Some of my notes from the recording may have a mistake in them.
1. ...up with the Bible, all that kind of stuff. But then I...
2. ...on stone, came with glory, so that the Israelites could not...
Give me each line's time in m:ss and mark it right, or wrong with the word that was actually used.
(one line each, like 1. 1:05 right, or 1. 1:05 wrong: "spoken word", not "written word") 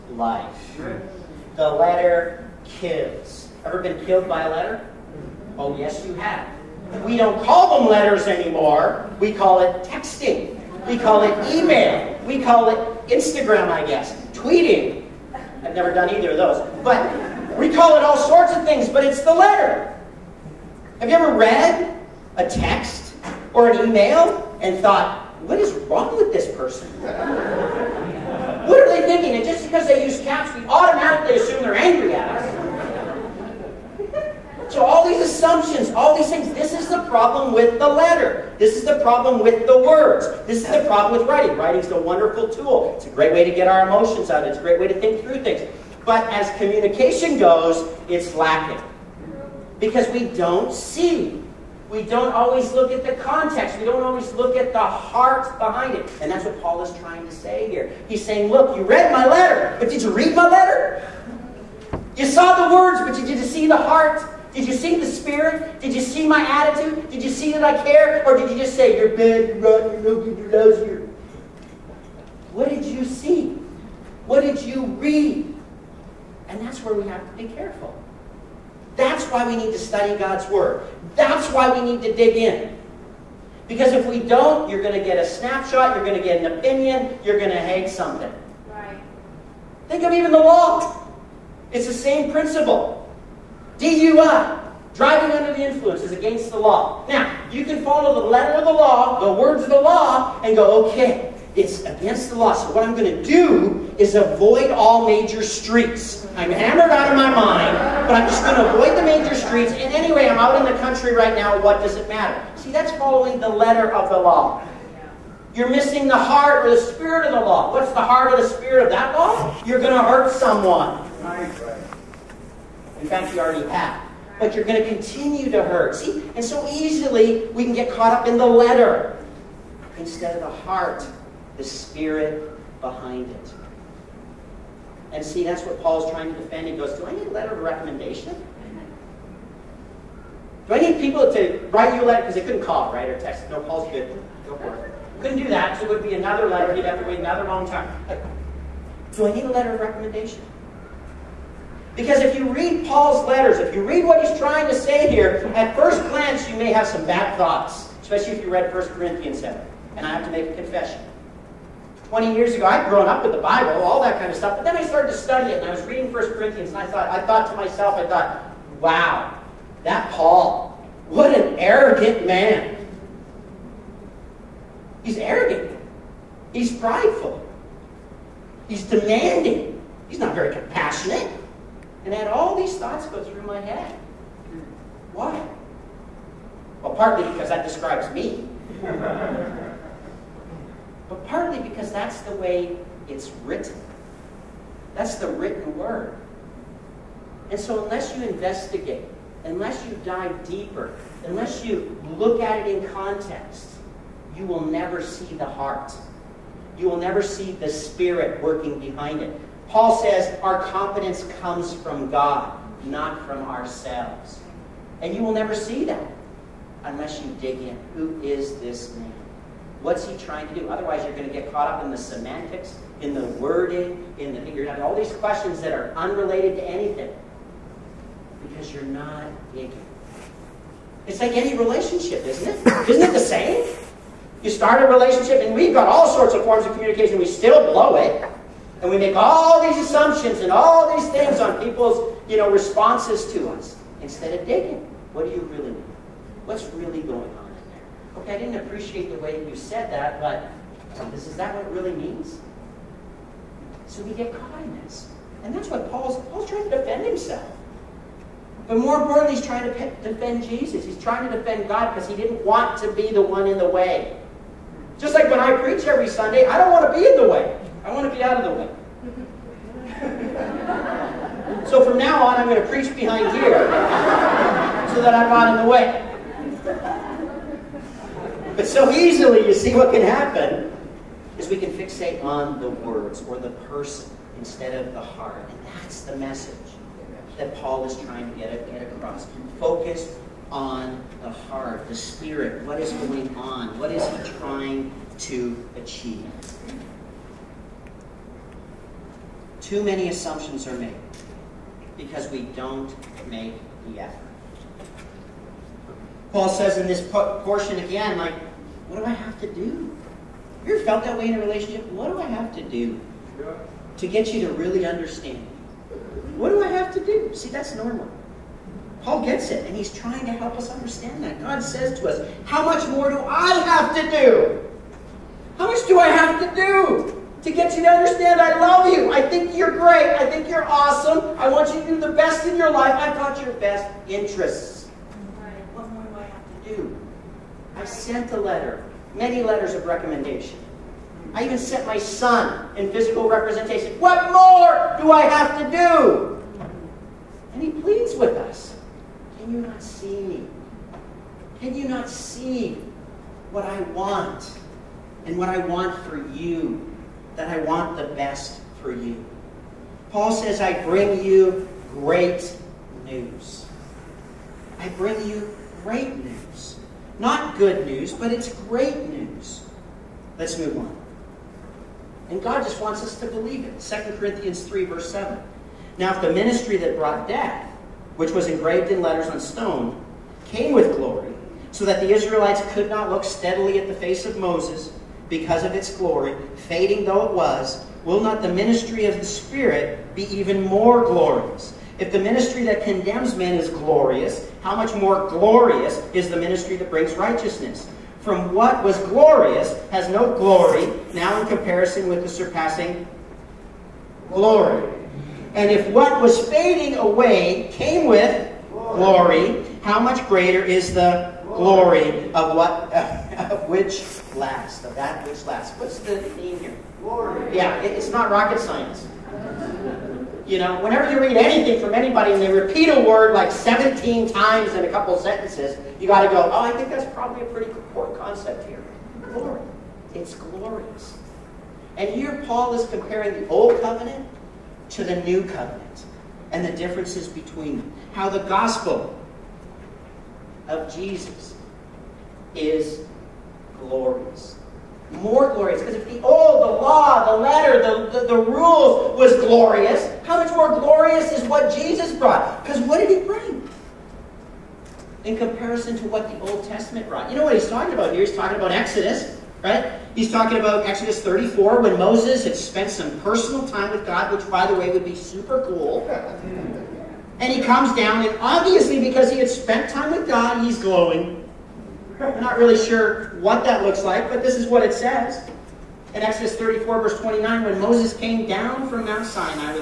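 1. 2:43 right
2. 6:19 right.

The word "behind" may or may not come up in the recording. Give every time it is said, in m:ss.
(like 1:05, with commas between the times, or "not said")
0:55, 2:12, 3:28, 4:32.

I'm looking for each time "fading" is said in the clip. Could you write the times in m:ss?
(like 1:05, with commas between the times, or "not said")
6:26, 6:46.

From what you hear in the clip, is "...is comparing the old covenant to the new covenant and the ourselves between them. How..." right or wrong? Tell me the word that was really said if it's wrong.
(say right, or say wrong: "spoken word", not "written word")
wrong: "differences", not "ourselves".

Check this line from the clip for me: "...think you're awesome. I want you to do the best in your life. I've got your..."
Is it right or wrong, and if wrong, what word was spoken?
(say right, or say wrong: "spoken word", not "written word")
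right.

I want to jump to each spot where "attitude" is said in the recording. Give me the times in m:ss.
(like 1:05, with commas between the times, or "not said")
1:06.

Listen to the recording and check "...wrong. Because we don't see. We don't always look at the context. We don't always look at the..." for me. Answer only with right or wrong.
wrong.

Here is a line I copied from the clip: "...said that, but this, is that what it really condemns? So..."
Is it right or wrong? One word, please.
wrong.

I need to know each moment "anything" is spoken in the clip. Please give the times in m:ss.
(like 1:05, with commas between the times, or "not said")
3:46, 7:01.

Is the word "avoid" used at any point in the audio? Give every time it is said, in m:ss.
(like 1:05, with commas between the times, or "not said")
1:44, 1:48.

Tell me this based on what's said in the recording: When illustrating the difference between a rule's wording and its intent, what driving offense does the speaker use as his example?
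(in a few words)
DUI.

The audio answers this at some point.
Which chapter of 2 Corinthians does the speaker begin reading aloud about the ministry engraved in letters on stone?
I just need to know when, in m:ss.
6:13.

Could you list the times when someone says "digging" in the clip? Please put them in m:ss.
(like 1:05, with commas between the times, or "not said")
3:49, 4:04.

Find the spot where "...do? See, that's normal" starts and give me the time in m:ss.
5:17.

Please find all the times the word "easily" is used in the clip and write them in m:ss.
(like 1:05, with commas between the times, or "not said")
2:06, 4:38.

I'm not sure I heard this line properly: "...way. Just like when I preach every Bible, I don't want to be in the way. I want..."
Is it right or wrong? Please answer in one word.
wrong.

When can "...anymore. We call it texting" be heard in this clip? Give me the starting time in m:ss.
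0:08.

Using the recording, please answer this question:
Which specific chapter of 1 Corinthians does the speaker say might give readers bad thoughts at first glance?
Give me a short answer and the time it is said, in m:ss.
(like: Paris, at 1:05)
Chapter 7, at 2:38.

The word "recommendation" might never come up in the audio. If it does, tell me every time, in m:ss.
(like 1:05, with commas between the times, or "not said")
2:17, 2:29, 5:39.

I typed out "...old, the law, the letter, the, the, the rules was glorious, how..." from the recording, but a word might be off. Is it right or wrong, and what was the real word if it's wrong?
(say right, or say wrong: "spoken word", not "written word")
right.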